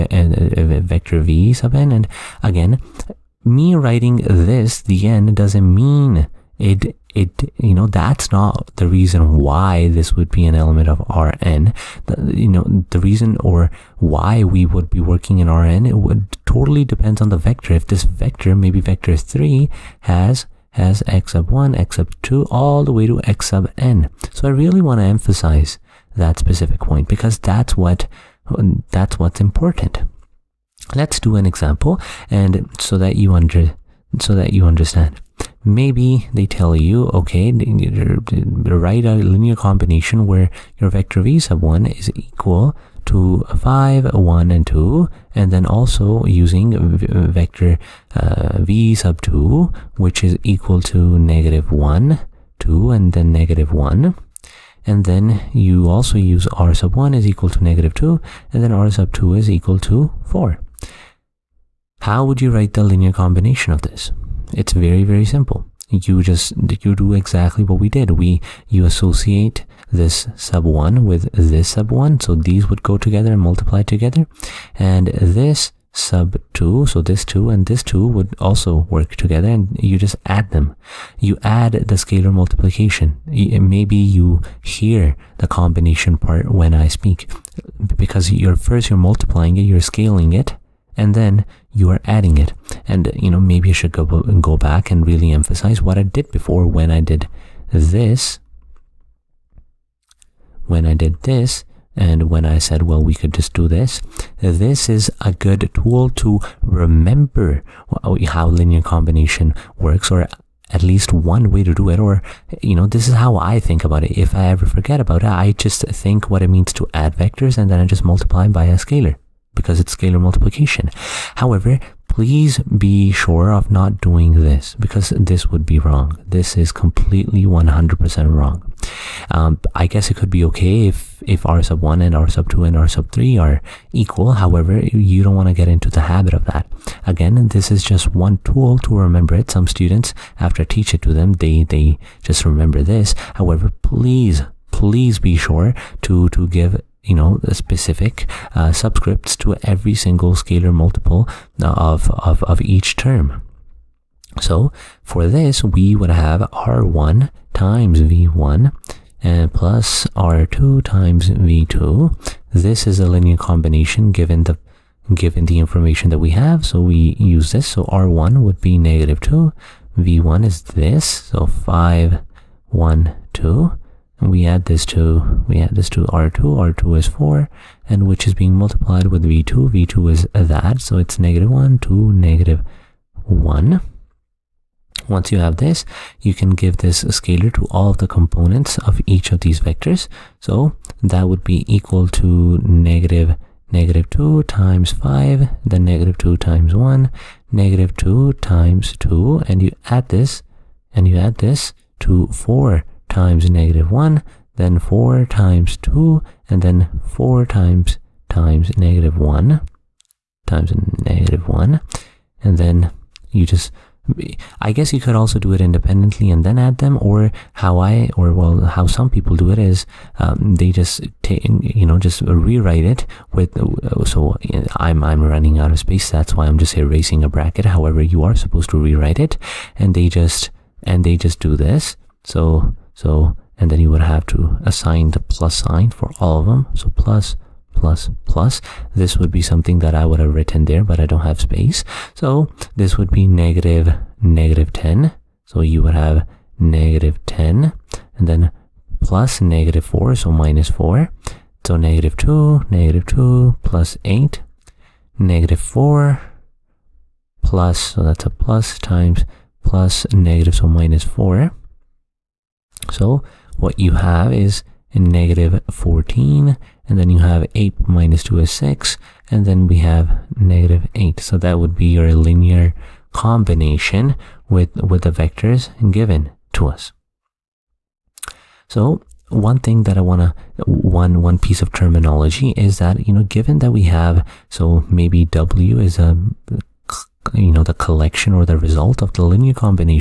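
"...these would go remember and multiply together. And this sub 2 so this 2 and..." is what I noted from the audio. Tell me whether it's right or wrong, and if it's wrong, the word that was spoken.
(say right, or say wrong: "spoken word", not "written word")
wrong: "together", not "remember".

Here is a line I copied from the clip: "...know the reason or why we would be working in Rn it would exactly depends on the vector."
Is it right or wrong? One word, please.
wrong.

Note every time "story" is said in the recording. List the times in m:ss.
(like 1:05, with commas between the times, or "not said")
not said.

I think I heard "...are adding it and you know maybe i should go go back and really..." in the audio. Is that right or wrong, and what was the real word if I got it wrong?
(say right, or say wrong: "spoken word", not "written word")
right.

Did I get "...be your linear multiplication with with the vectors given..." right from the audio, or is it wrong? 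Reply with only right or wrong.
wrong.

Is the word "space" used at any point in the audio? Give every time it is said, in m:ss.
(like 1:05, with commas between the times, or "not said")
3:45, 4:01.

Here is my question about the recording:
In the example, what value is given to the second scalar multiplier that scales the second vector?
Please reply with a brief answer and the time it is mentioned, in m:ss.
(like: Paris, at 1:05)
4, at 0:58.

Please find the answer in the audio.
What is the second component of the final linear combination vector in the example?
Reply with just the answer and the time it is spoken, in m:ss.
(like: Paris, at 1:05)
6, at 4:27.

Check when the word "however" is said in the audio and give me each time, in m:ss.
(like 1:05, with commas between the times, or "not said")
2:01, 2:14, 2:23, 3:47.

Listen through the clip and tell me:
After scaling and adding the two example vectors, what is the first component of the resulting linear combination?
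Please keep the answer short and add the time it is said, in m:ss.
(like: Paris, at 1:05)
-14, at 4:24.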